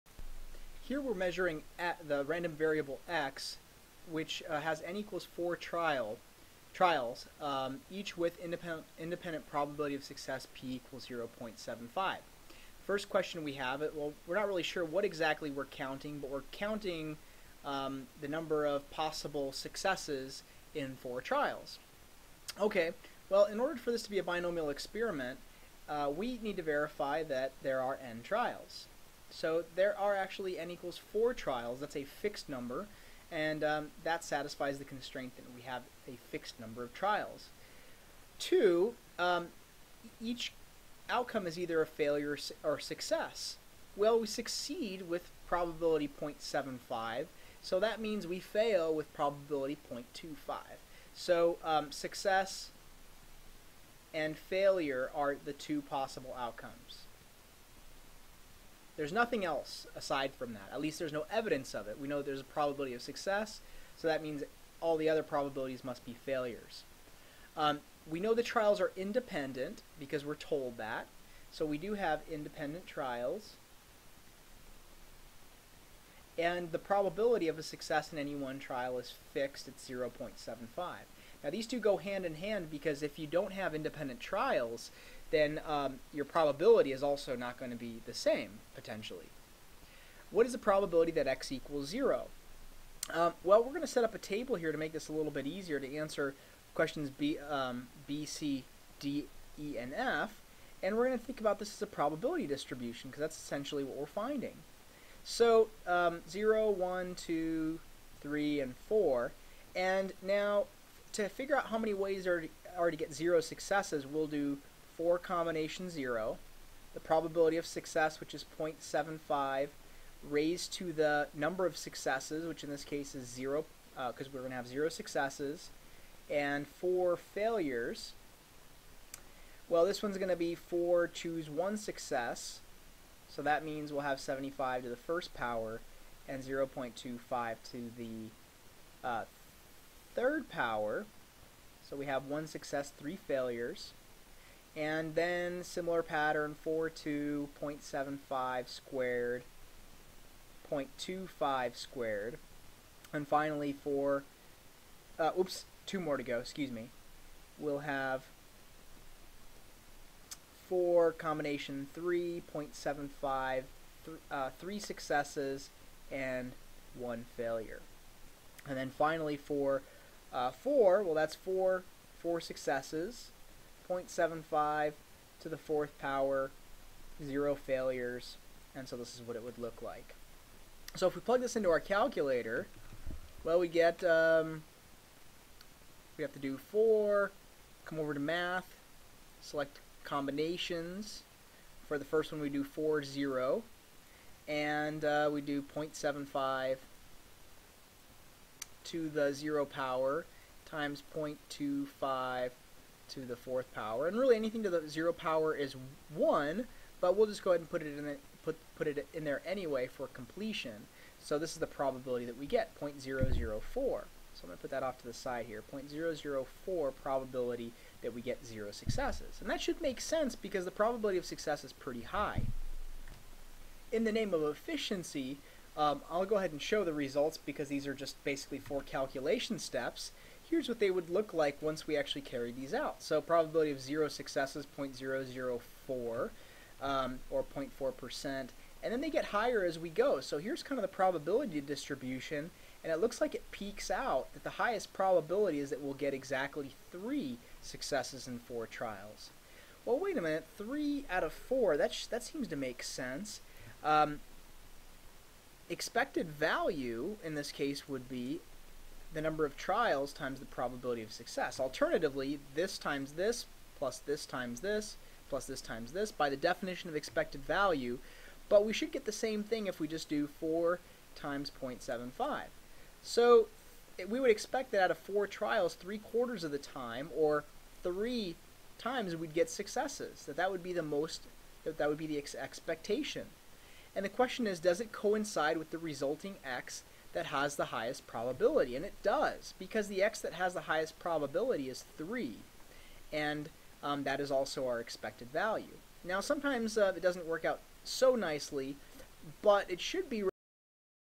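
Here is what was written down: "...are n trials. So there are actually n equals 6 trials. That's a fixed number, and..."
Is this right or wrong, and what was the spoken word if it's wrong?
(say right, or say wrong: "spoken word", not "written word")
wrong: "4", not "6".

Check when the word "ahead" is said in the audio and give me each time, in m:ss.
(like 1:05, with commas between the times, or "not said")
3:27, 3:46.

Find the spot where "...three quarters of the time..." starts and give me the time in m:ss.
4:35.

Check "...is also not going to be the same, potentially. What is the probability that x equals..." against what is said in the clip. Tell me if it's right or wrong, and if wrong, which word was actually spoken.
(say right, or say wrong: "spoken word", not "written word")
right.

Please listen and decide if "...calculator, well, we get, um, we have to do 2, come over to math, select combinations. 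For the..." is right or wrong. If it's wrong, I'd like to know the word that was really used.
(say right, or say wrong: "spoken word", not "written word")
wrong: "4", not "2".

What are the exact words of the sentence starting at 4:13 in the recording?
Um, expected value in this case would be the number of trials times the probability of success.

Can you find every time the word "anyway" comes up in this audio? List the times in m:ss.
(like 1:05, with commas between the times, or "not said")
3:29.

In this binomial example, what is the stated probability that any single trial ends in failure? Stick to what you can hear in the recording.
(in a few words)
0.25.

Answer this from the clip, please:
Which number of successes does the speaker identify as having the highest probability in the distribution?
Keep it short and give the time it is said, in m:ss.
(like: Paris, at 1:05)
3, at 4:06.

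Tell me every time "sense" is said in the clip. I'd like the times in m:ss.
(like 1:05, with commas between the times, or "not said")
3:40, 4:12.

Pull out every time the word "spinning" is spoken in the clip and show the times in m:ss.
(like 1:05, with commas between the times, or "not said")
not said.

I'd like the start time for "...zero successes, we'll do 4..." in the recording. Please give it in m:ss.
1:53.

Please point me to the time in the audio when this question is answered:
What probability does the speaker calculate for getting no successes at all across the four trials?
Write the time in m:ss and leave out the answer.
3:32.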